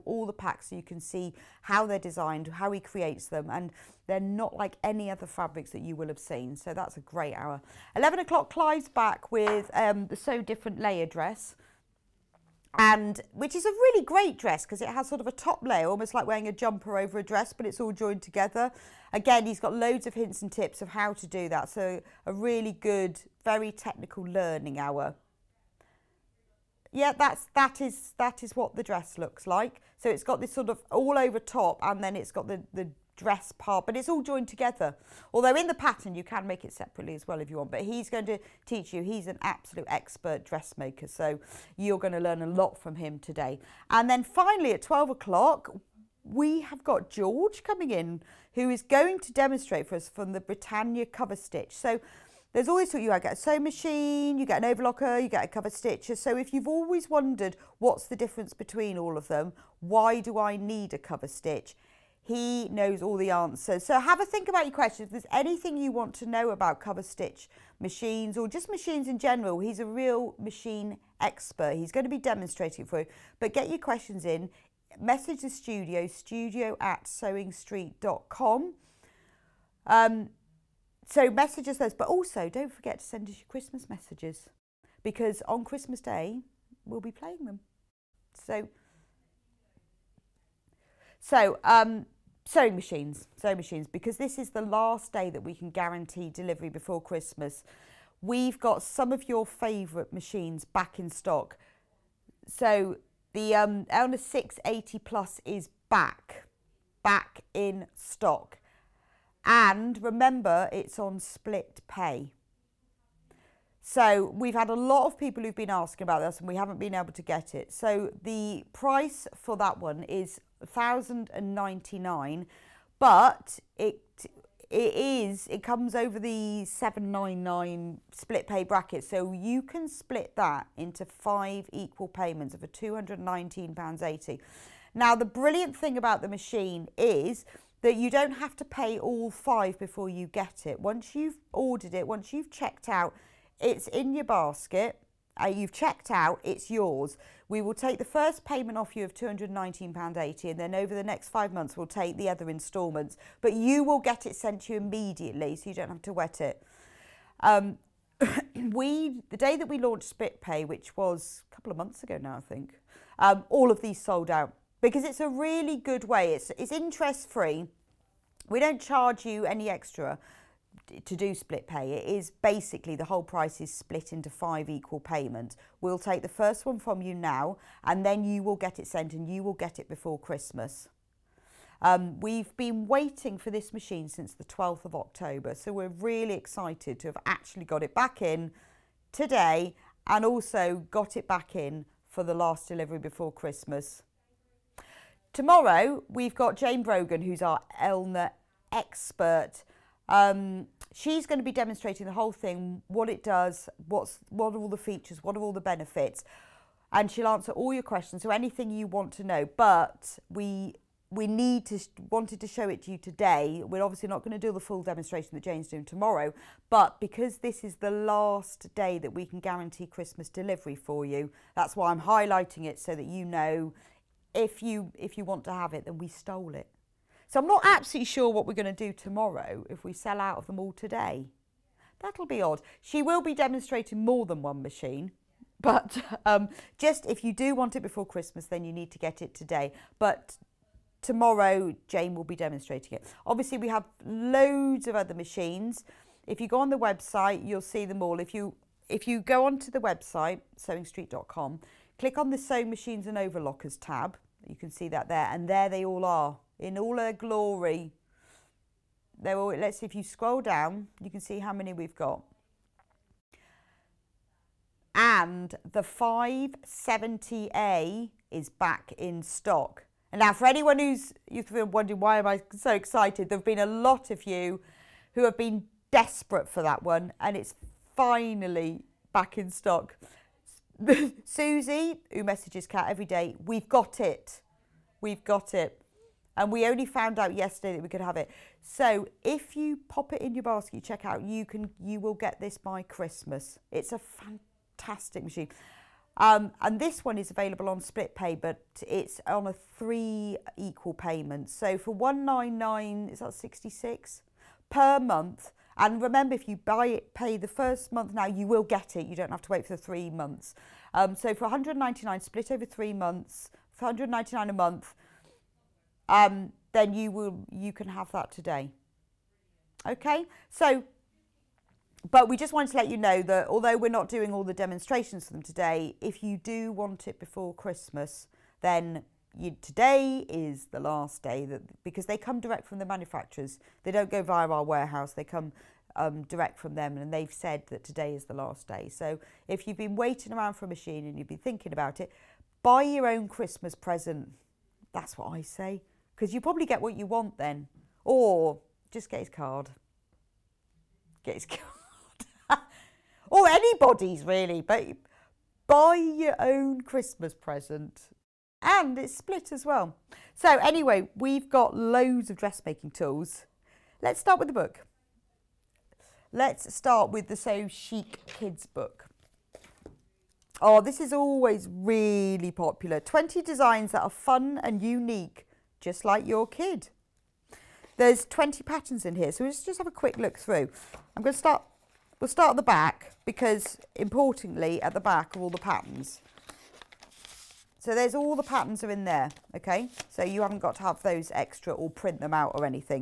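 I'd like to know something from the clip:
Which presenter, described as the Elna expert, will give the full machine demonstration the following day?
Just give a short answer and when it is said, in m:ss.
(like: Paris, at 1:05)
Jane Brogan, at 3:16.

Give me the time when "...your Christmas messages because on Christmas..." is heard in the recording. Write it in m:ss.
1:23.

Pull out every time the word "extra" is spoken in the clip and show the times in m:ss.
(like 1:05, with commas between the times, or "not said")
2:49, 6:31.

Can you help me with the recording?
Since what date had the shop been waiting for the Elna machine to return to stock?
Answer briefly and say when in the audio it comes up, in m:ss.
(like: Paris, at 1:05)
12th of October, at 3:04.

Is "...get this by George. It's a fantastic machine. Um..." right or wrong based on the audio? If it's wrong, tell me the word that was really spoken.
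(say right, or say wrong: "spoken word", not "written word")
wrong: "Christmas", not "George".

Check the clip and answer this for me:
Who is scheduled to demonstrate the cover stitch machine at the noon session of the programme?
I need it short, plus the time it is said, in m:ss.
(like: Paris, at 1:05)
George, at 0:47.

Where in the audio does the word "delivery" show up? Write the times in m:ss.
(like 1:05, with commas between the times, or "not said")
1:36, 3:12, 3:40.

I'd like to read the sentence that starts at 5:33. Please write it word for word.
They don't go via our warehouse.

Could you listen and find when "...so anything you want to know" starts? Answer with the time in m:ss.
3:28.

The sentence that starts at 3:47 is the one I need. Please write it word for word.
So I'm not absolutely sure what we're going to do tomorrow if we sell out of them all today.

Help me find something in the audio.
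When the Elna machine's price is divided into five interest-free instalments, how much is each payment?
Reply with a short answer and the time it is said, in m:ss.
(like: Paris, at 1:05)
£219.80, at 2:12.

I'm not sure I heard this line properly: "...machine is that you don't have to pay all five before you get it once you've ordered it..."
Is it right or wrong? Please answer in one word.
right.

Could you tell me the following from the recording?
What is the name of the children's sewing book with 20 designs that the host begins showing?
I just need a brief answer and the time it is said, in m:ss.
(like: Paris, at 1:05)
Sew Chic Kids, at 6:07.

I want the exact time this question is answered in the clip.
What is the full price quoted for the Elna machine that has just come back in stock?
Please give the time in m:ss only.
2:00.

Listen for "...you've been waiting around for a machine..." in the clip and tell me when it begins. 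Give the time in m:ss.
5:39.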